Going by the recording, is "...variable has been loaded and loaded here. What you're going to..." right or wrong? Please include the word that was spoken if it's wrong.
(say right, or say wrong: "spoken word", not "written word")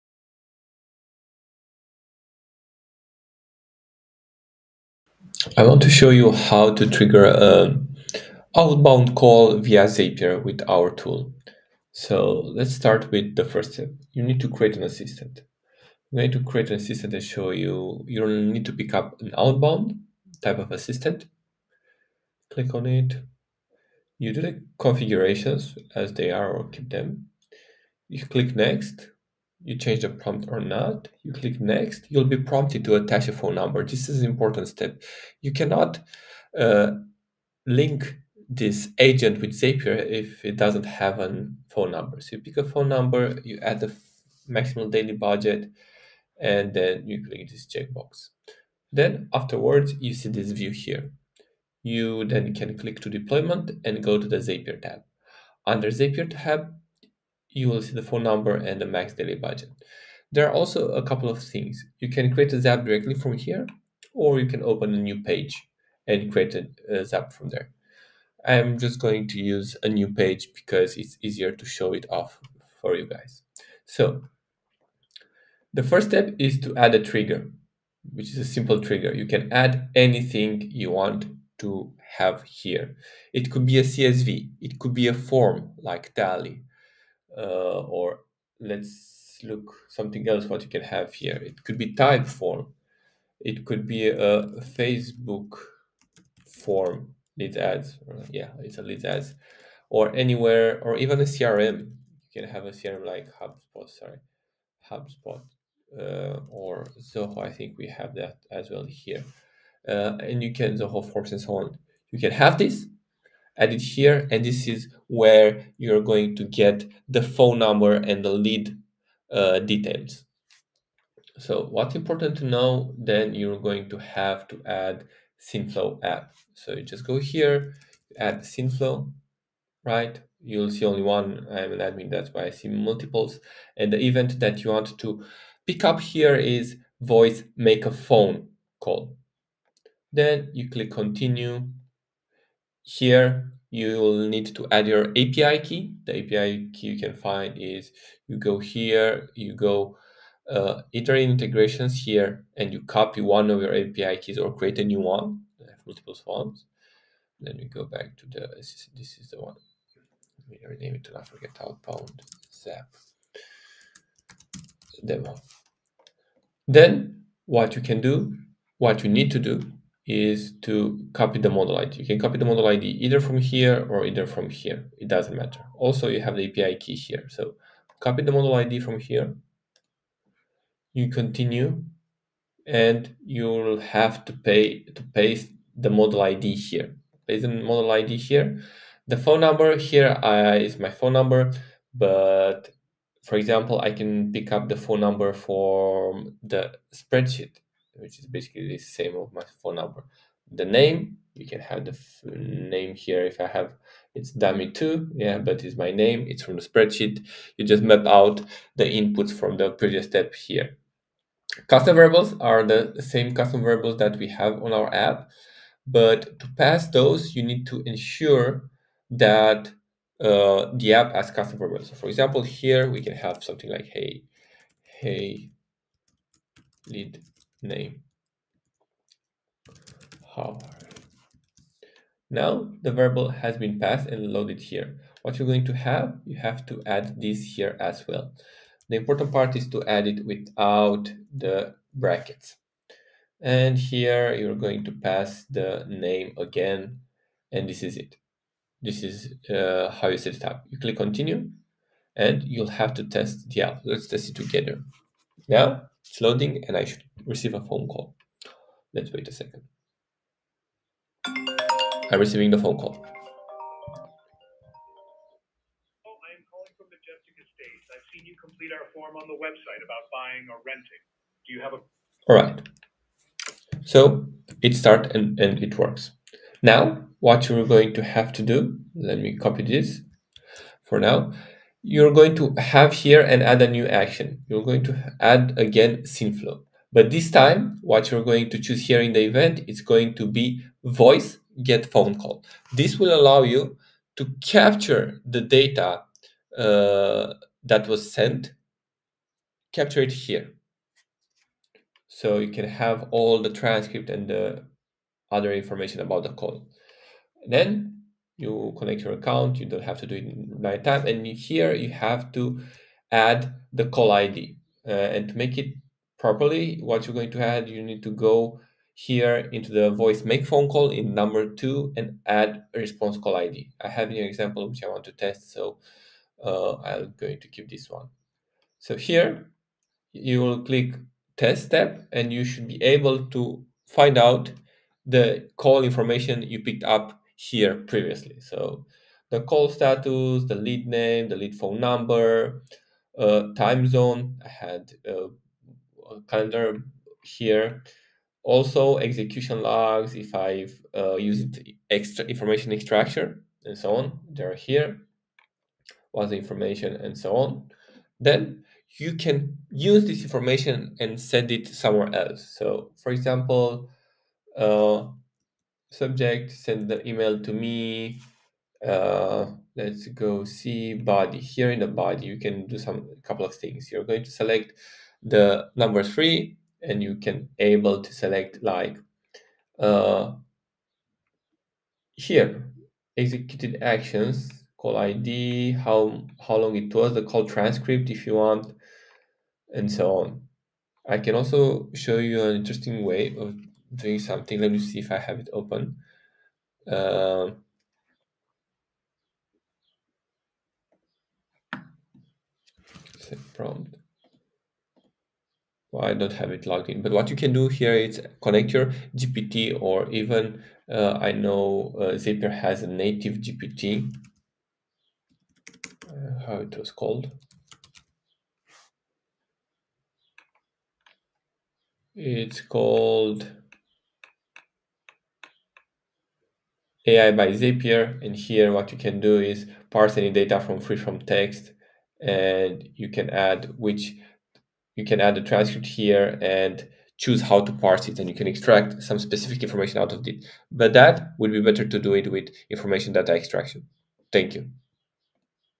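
wrong: "passed", not "loaded".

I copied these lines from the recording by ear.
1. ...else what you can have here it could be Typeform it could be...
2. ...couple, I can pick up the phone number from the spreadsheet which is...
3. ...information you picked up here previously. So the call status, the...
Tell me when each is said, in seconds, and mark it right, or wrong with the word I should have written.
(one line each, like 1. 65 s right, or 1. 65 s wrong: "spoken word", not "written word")
1. 90 s right
2. 193 s wrong: "example", not "couple"
3. 335 s right.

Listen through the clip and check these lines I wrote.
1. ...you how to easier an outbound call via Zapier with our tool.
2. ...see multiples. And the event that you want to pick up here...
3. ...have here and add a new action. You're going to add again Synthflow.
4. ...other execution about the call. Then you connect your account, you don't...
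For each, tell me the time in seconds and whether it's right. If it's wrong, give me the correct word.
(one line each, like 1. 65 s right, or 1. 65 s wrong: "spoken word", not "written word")
1. 6 s wrong: "trigger", not "easier"
2. 132 s right
3. 282 s right
4. 305 s wrong: "information", not "execution".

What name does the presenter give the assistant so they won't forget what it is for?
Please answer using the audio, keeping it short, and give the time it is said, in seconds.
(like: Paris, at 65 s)
Outbound zap demo, at 161 s.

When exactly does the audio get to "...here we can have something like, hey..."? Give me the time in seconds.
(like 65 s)
222 s.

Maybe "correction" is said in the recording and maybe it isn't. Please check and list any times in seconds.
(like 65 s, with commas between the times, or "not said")
not said.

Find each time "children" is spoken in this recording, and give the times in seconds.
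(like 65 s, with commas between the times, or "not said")
not said.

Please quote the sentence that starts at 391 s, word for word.
I can also show you an interesting way of doing something.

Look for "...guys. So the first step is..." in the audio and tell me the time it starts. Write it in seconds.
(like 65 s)
73 s.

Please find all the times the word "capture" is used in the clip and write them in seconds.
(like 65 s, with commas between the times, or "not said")
294 s, 299 s.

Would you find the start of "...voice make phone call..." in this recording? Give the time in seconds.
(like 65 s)
319 s.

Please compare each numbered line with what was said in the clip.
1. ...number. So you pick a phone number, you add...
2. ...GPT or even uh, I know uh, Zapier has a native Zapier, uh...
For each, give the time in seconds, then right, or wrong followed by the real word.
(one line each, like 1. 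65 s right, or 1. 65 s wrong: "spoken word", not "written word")
1. 41 s right
2. 409 s wrong: "GPT", not "Zapier".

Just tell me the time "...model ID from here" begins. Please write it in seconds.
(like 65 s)
178 s.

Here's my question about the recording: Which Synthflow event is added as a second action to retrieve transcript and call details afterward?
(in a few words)
Voice get phone call.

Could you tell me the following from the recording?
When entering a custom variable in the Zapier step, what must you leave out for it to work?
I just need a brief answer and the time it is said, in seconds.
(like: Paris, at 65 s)
The brackets, at 240 s.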